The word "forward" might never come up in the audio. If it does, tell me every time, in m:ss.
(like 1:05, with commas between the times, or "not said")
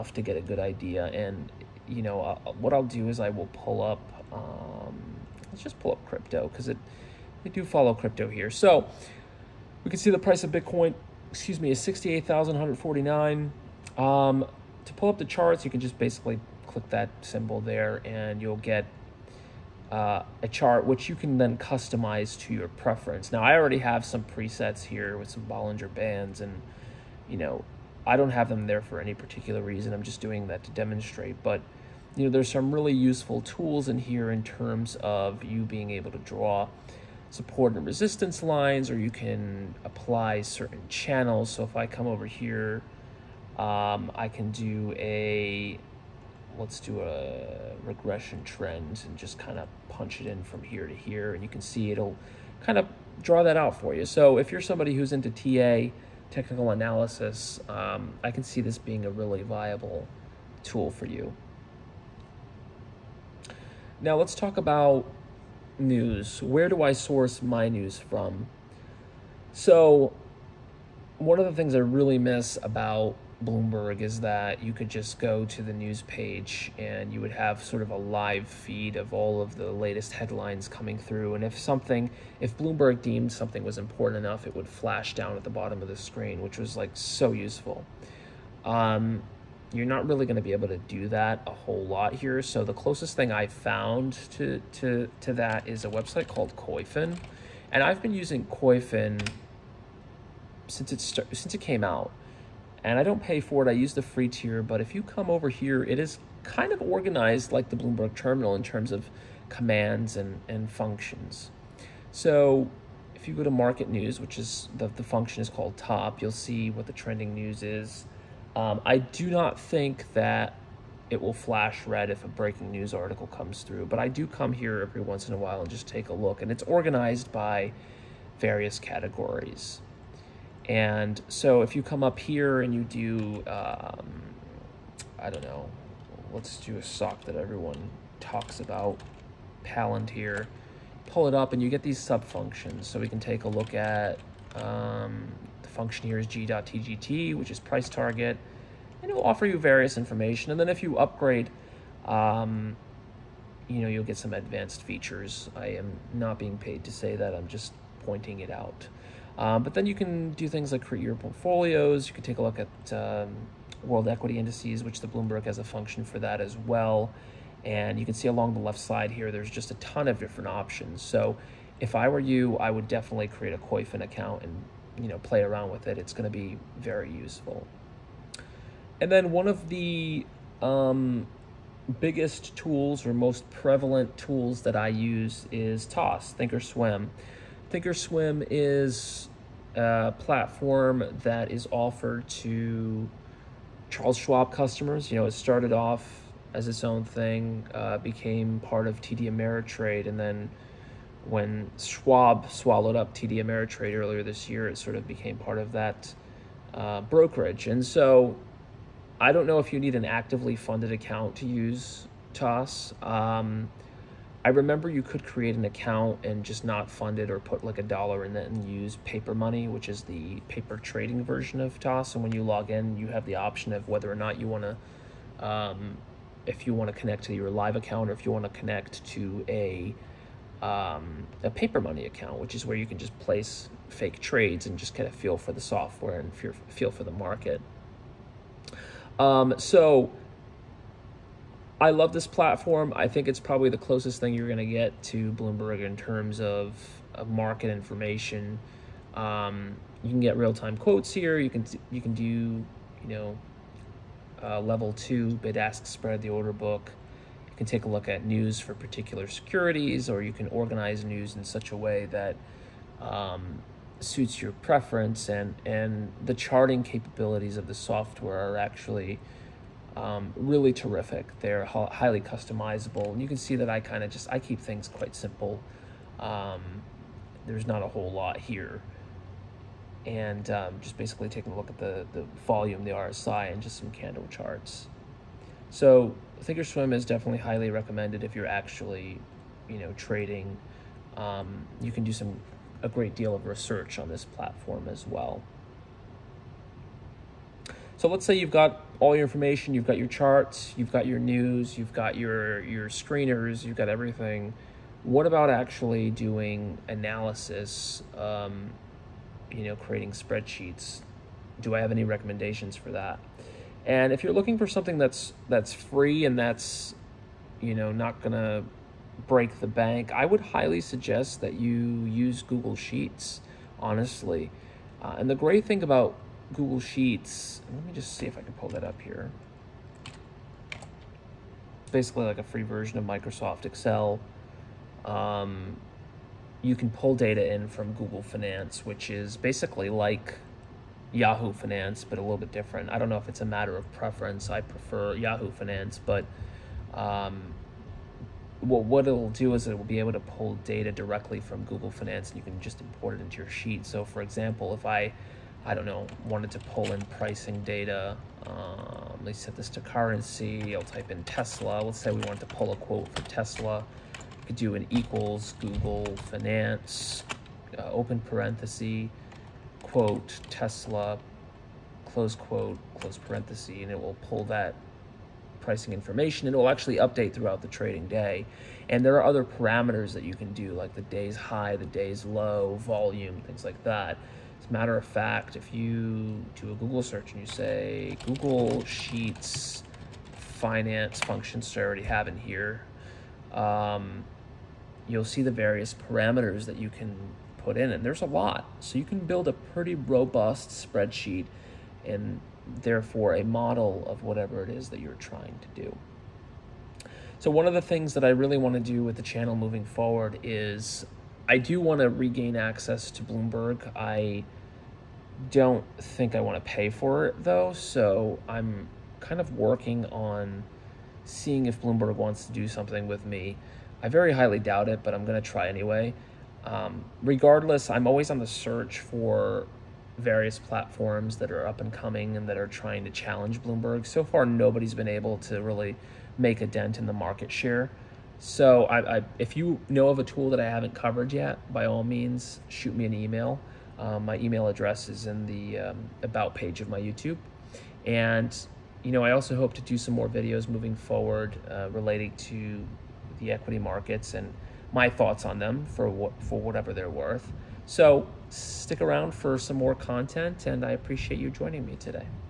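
6:49, 7:30.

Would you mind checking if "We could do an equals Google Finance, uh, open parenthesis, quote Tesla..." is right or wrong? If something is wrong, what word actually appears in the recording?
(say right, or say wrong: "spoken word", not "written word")
right.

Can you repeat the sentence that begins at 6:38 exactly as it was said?
So you can build a pretty robust spreadsheet and therefore a model of whatever it is that you're trying to do.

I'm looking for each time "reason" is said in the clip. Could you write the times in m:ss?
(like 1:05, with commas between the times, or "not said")
0:29.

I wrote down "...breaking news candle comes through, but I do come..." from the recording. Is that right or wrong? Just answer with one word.
wrong.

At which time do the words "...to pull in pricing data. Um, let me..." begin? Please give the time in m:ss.
5:56.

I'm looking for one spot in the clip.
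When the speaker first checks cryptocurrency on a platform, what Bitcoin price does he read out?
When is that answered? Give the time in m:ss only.
0:11.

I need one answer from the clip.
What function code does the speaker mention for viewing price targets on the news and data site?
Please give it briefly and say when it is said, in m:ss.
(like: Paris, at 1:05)
g.tgt, at 2:26.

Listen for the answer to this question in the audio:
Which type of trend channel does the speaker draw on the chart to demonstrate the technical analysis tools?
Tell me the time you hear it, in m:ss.
0:47.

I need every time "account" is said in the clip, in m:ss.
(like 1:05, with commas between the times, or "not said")
2:54, 3:30, 3:35, 3:47, 3:52.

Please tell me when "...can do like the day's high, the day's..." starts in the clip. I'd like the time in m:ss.
6:20.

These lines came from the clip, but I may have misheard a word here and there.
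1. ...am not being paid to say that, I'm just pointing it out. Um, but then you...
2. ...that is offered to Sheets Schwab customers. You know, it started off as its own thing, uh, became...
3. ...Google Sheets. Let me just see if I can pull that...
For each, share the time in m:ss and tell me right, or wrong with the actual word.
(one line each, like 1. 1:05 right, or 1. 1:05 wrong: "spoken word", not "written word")
1. 2:35 right
2. 3:11 wrong: "Charles", not "Sheets"
3. 5:26 right.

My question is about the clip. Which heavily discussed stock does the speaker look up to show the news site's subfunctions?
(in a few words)
Palantir.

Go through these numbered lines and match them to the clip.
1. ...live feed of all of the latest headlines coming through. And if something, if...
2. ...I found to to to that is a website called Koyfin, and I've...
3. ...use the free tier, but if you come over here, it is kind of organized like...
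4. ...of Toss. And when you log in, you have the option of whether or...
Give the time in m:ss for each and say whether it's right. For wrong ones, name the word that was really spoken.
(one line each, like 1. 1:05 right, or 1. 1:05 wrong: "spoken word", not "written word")
1. 1:17 right
2. 1:33 right
3. 1:43 right
4. 3:41 right.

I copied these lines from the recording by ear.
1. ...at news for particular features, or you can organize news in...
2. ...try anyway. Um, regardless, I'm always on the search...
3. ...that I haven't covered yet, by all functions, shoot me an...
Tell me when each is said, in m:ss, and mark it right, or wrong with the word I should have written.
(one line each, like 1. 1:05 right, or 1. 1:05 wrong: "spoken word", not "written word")
1. 4:18 wrong: "securities", not "features"
2. 7:05 right
3. 7:20 wrong: "means", not "functions".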